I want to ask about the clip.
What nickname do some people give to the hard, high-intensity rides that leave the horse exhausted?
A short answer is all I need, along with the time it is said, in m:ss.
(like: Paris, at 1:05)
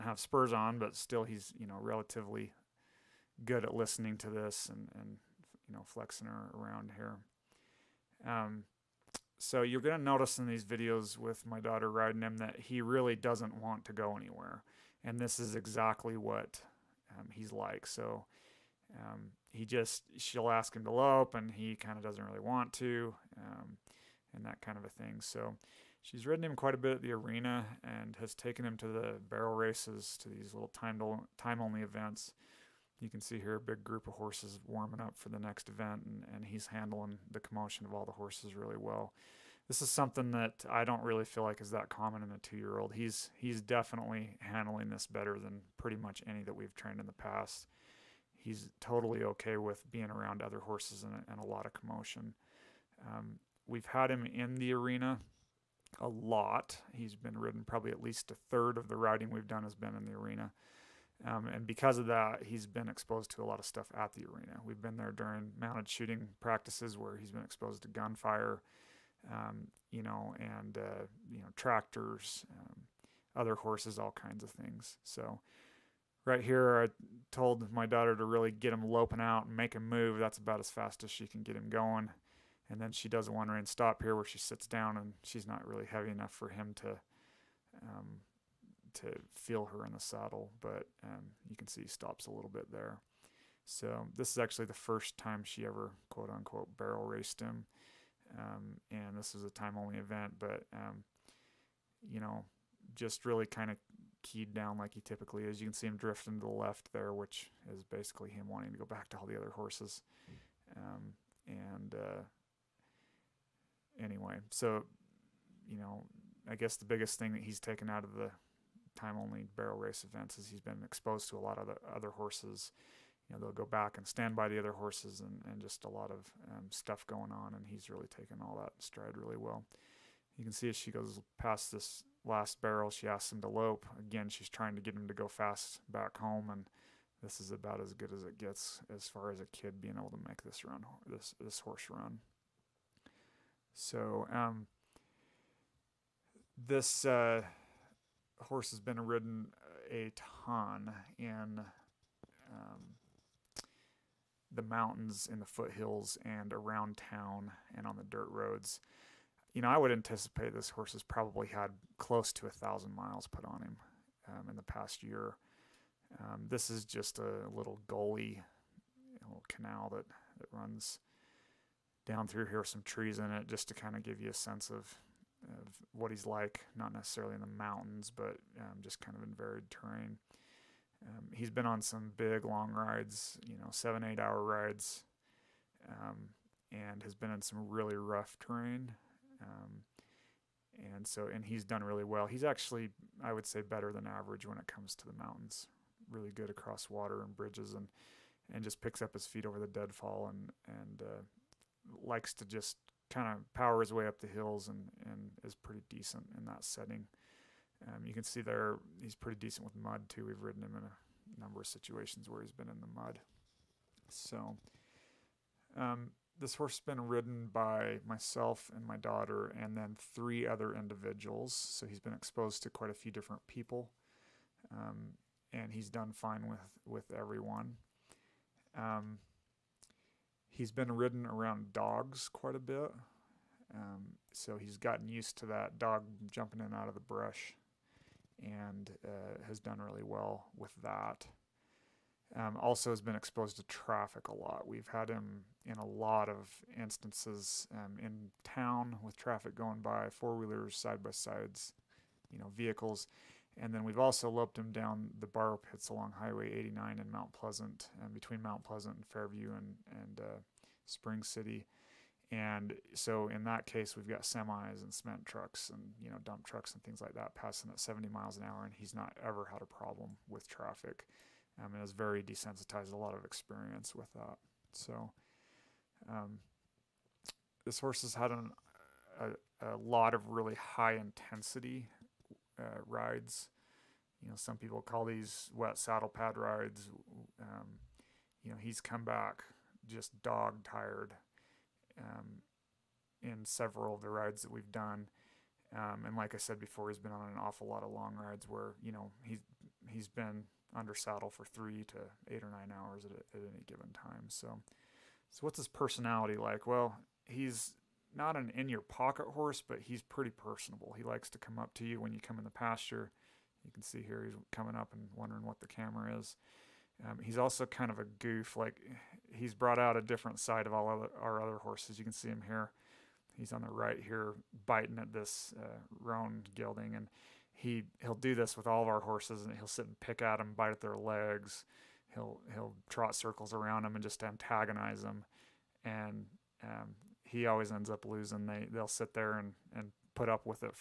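Wet saddle pad rides, at 4:45.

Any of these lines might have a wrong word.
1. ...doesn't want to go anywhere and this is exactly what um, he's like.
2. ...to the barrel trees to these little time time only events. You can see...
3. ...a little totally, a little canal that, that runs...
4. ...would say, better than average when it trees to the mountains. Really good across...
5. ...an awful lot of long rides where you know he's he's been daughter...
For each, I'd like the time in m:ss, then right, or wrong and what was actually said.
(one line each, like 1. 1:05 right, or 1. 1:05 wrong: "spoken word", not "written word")
1. 0:13 right
2. 0:28 wrong: "races", not "trees"
3. 2:47 wrong: "gully", not "totally"
4. 3:13 wrong: "comes", not "trees"
5. 4:57 wrong: "under", not "daughter".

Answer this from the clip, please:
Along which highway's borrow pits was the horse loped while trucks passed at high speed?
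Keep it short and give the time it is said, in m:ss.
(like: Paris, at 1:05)
Highway 89, at 4:16.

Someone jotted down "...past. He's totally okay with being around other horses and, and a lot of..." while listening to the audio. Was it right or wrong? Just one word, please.
right.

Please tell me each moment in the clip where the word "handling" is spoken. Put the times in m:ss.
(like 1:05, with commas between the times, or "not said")
0:36, 0:44.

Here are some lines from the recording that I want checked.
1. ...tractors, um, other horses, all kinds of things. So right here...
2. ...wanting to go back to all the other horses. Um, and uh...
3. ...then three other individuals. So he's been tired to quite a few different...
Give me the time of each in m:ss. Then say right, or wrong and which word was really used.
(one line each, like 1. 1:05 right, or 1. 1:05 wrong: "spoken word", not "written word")
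1. 1:11 right
2. 1:48 right
3. 3:39 wrong: "exposed", not "tired".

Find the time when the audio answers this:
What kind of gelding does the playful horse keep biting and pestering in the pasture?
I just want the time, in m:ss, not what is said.
5:25.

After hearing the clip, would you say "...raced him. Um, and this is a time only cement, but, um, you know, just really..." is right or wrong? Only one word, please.
wrong.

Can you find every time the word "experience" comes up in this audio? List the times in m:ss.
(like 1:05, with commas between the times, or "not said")
4:33.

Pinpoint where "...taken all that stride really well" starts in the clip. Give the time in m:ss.
2:08.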